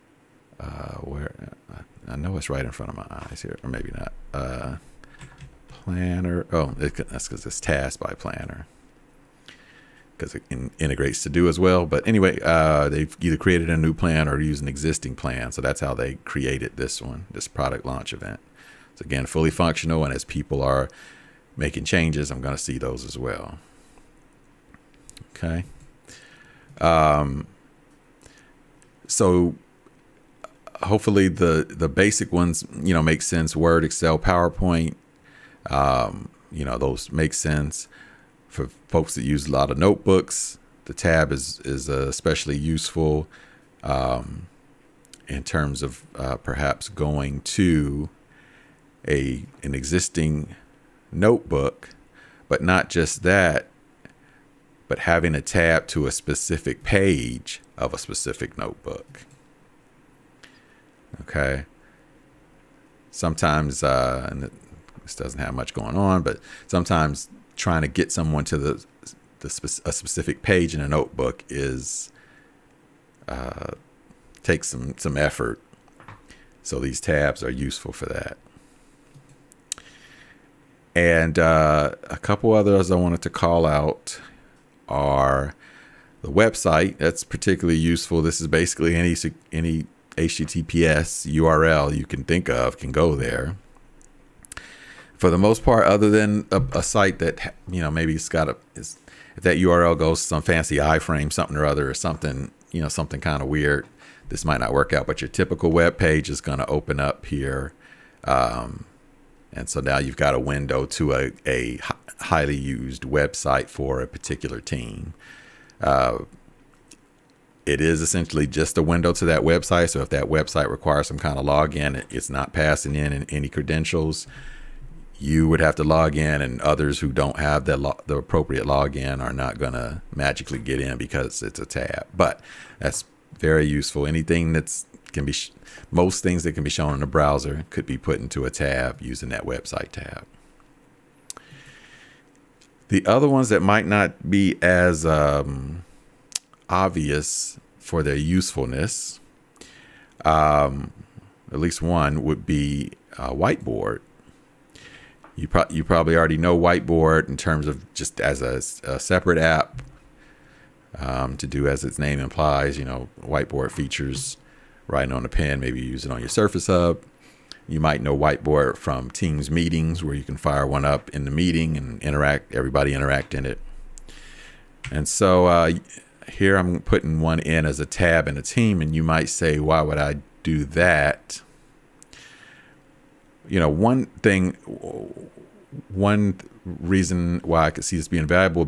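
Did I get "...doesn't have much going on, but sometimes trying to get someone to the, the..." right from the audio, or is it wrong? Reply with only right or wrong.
right.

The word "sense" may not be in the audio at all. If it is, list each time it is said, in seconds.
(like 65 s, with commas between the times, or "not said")
33 s, 37 s.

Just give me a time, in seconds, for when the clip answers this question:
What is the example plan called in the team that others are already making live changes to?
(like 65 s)
17 s.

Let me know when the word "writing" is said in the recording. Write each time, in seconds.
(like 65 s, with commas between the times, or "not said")
164 s.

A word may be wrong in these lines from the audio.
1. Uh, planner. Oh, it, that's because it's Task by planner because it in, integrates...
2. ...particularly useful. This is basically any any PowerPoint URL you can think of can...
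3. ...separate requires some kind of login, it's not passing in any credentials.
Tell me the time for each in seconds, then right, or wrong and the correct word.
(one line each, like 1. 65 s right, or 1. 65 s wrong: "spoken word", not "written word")
1. 4 s right
2. 87 s wrong: "HTTPS", not "PowerPoint"
3. 120 s wrong: "website", not "separate".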